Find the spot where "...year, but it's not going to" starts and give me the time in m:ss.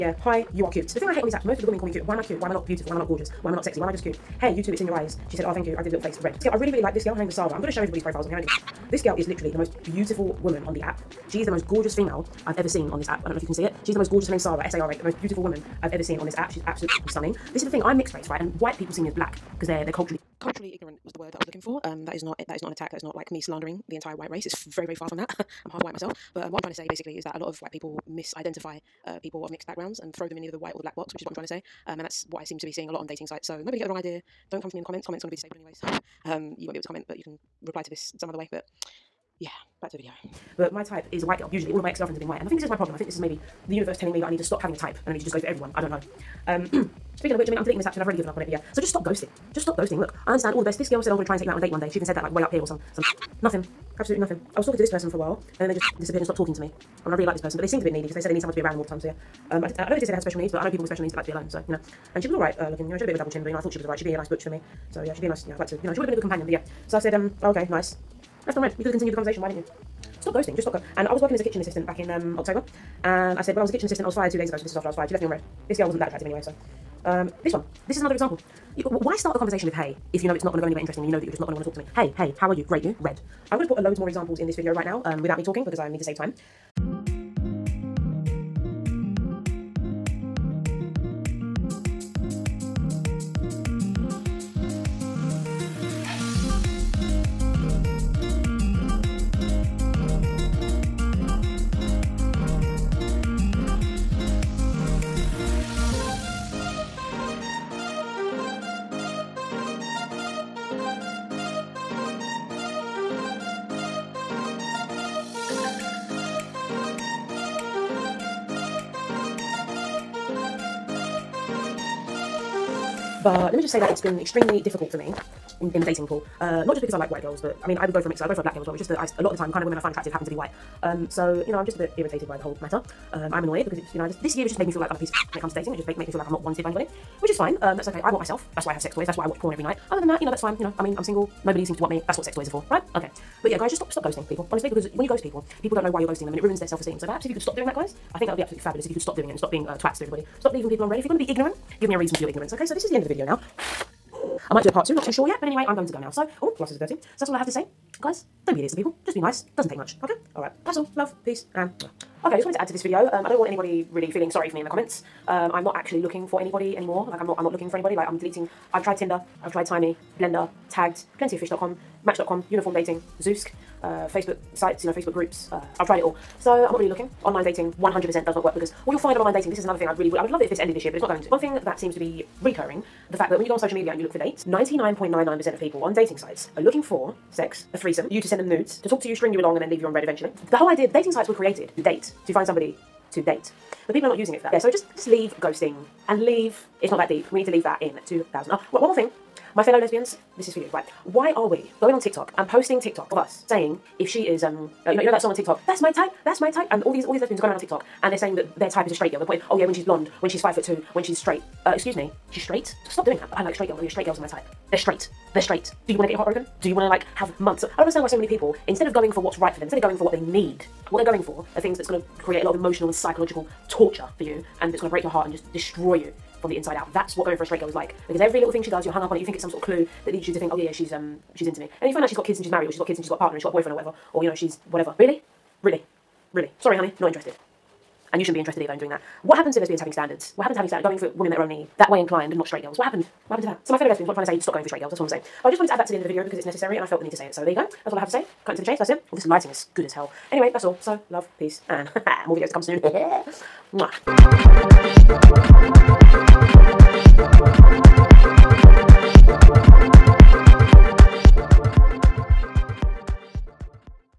3:00.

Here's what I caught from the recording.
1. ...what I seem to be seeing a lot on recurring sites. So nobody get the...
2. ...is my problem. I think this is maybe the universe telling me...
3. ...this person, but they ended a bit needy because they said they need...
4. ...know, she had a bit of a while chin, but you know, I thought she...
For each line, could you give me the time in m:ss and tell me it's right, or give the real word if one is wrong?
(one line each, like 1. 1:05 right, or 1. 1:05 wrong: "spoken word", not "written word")
1. 0:32 wrong: "dating", not "recurring"
2. 0:42 right
3. 0:57 wrong: "seemed", not "ended"
4. 1:02 wrong: "double", not "while".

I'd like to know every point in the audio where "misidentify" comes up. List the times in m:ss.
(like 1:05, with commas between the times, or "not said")
0:28.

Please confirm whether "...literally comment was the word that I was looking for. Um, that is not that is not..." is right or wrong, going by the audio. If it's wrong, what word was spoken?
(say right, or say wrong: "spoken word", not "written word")
wrong: "ignorant", not "comment".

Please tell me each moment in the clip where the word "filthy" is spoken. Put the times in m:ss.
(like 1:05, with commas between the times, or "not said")
not said.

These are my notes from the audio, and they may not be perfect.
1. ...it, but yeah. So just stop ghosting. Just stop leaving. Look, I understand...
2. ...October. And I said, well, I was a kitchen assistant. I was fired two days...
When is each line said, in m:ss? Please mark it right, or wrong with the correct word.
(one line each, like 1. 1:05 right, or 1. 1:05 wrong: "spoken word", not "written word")
1. 0:48 wrong: "ghosting", not "leaving"
2. 1:12 right.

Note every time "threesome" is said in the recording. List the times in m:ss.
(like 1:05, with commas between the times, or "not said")
3:07.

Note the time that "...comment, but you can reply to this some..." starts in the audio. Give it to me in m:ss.
0:36.